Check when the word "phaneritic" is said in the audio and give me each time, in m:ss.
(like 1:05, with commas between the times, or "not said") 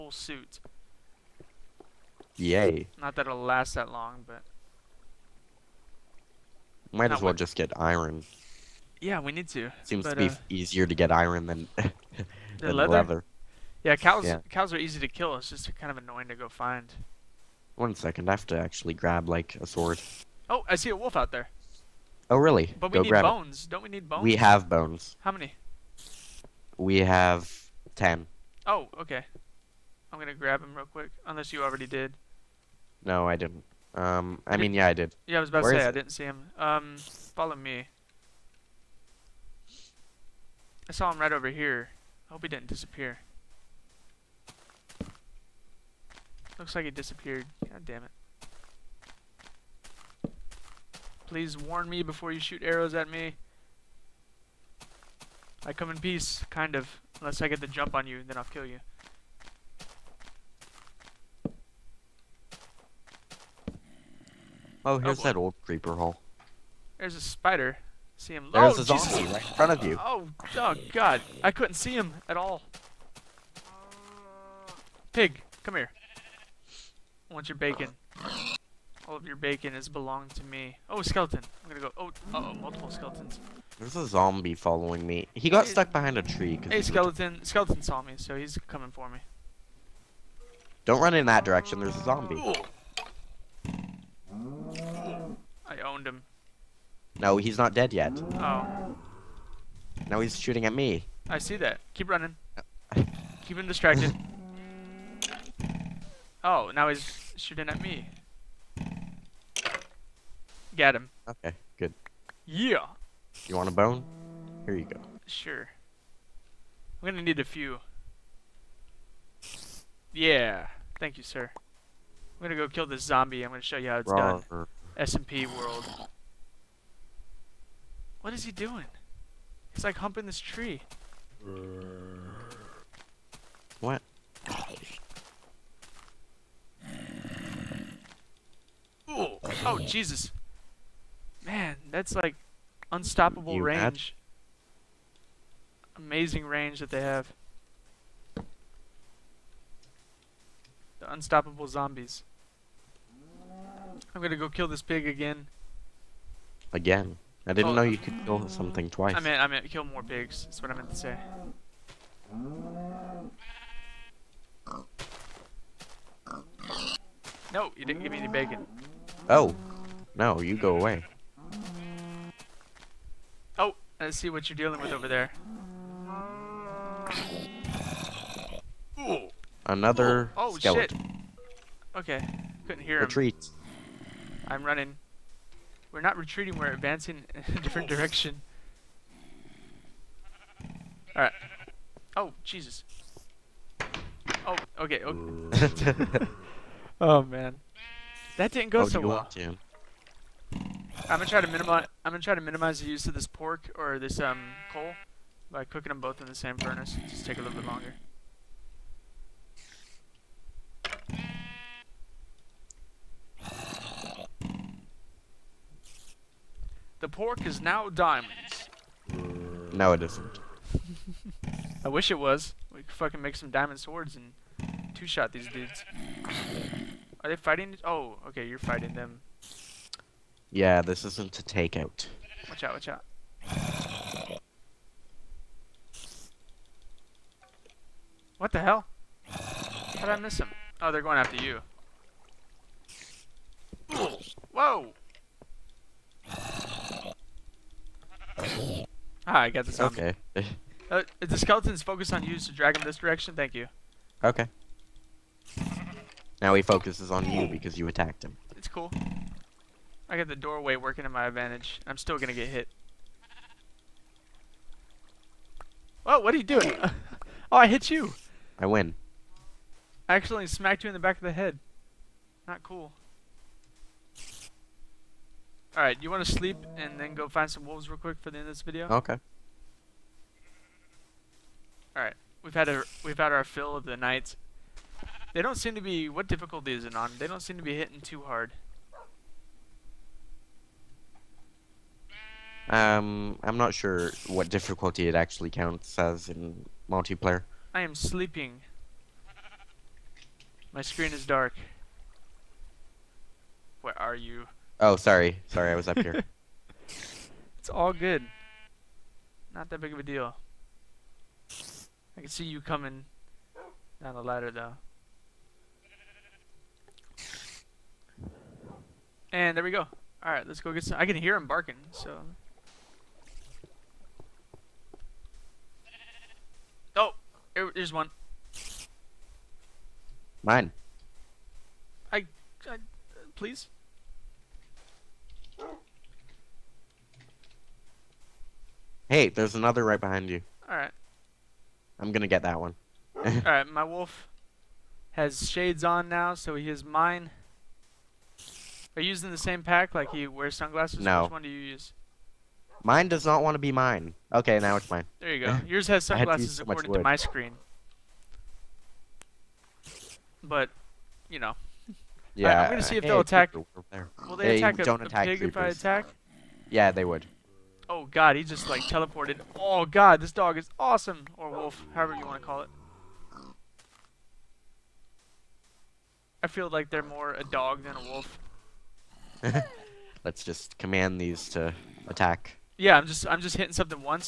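not said.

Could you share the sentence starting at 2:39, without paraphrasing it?
I meant, I meant kill more pigs.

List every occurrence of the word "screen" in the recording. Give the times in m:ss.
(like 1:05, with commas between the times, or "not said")
5:00, 5:57.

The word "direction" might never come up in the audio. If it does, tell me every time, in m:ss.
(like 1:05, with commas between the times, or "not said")
1:31, 3:07, 4:12.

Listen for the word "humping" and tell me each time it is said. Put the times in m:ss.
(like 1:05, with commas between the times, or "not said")
2:09.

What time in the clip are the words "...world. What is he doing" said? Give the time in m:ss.
2:05.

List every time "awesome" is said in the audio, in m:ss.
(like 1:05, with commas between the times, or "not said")
6:10.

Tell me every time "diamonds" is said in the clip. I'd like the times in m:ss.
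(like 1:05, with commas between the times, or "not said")
3:37, 3:43.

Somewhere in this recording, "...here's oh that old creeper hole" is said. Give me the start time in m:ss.
1:04.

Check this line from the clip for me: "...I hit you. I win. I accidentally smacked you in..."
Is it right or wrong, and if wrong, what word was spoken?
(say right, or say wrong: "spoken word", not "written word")
right.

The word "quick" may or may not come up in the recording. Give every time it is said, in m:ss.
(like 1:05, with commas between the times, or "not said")
0:30, 4:37.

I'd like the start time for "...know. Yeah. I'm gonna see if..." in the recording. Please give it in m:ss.
6:01.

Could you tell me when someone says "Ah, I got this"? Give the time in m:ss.
4:09.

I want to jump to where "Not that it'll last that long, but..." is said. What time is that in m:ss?
0:02.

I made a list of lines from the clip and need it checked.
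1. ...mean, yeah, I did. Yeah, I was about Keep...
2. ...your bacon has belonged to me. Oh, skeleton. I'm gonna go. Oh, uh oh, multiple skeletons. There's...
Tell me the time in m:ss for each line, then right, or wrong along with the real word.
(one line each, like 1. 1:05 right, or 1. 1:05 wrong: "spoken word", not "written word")
1. 0:34 wrong: "Where", not "Keep"
2. 1:19 right.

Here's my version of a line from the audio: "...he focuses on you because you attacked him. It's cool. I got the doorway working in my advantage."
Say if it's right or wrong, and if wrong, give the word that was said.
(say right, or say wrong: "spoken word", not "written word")
right.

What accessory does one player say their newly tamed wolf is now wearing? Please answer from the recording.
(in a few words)
shades.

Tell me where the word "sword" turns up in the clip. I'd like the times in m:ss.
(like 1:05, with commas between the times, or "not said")
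0:19, 3:43.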